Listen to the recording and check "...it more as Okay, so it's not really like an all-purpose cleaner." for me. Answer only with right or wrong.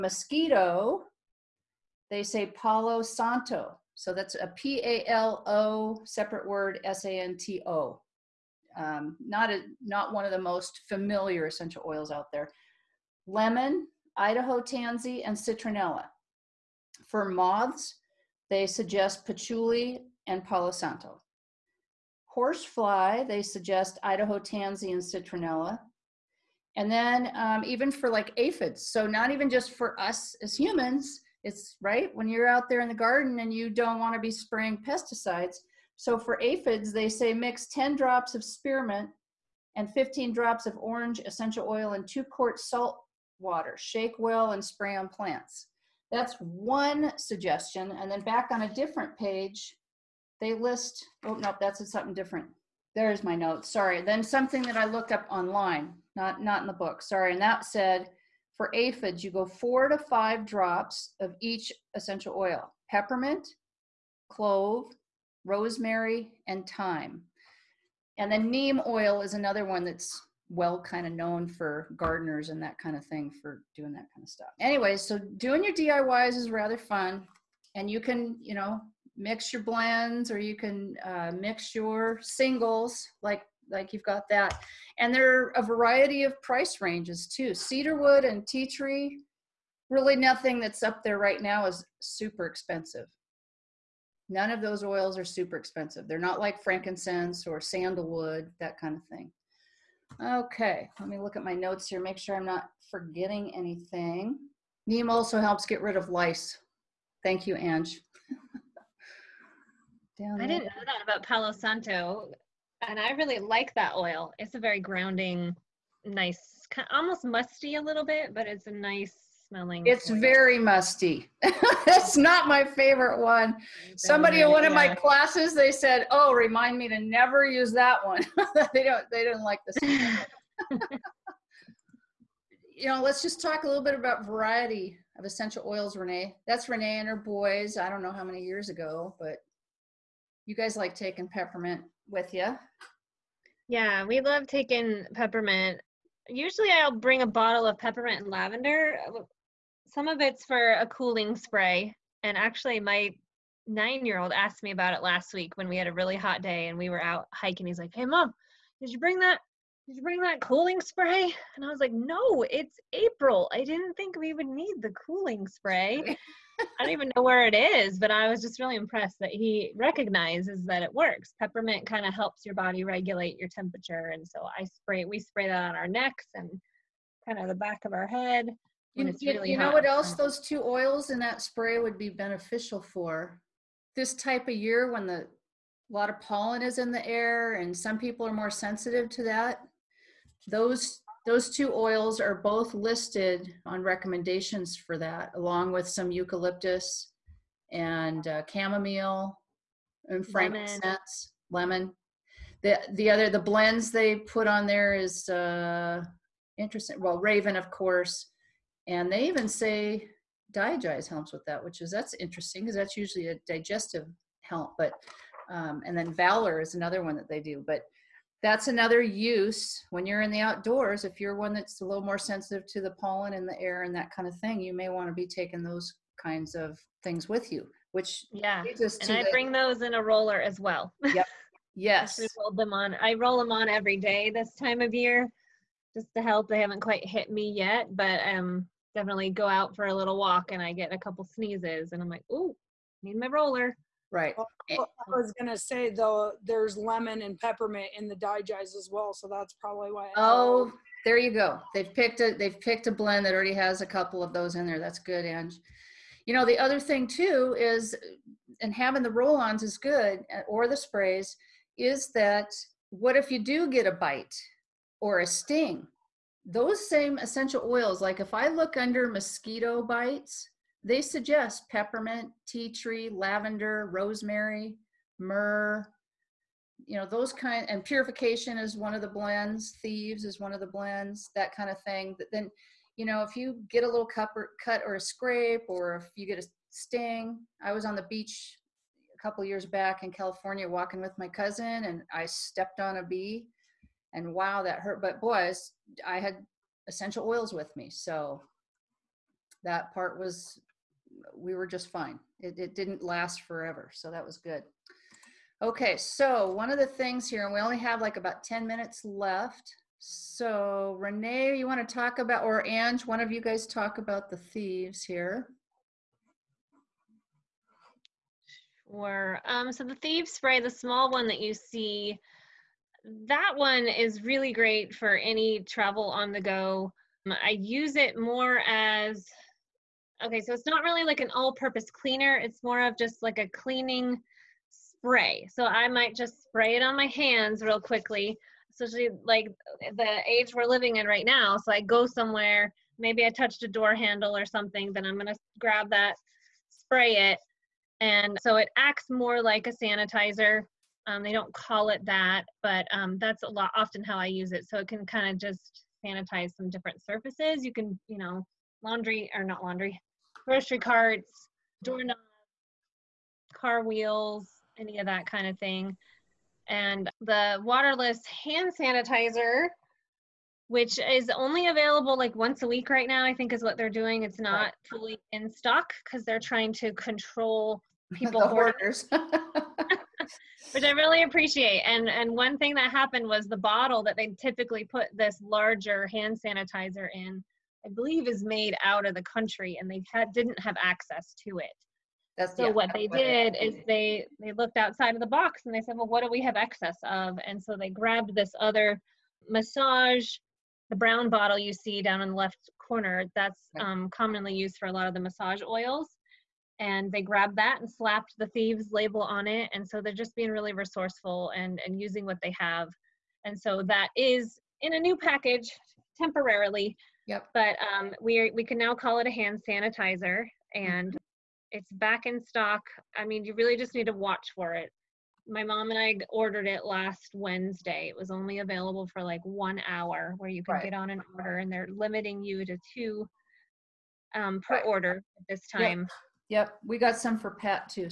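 right.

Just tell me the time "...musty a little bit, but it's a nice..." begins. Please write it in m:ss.
1:57.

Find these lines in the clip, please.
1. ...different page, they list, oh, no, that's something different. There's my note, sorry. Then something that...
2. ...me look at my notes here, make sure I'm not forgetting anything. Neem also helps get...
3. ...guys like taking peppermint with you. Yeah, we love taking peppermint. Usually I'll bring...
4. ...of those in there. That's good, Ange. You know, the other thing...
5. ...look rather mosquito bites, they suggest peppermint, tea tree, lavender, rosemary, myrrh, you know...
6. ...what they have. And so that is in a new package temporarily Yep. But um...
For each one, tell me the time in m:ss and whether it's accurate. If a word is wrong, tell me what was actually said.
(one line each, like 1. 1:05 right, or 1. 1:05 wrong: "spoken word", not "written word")
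1. 0:48 right
2. 1:41 right
3. 2:20 right
4. 4:14 right
5. 4:28 wrong: "under", not "rather"
6. 6:52 right.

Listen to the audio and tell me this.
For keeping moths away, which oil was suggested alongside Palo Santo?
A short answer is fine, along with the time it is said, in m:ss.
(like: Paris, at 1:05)
Patchouli, at 0:19.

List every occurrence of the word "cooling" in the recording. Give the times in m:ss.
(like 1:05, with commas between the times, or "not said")
2:30, 2:40, 2:44.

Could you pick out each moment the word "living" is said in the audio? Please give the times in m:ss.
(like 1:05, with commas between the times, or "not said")
5:40.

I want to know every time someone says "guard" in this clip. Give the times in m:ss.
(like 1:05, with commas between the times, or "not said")
not said.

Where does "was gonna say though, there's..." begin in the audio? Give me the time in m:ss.
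4:05.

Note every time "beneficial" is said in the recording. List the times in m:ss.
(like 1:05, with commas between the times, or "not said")
3:02.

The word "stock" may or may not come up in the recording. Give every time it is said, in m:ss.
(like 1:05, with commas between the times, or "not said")
6:15, 7:02.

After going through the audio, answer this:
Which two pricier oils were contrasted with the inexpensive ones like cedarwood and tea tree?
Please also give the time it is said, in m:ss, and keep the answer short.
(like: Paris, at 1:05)
Frankincense or sandalwood, at 1:36.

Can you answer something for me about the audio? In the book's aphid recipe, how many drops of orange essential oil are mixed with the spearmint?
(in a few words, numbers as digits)
15.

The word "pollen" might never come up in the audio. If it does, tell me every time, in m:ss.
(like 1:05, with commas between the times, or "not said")
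3:06, 3:42.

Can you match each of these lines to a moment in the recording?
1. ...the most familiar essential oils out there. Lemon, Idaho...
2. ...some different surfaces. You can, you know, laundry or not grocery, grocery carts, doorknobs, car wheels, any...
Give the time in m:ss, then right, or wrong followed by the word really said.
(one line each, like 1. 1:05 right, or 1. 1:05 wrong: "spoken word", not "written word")
1. 0:10 right
2. 5:56 wrong: "laundry", not "grocery".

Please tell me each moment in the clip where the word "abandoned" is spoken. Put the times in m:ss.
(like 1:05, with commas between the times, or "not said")
not said.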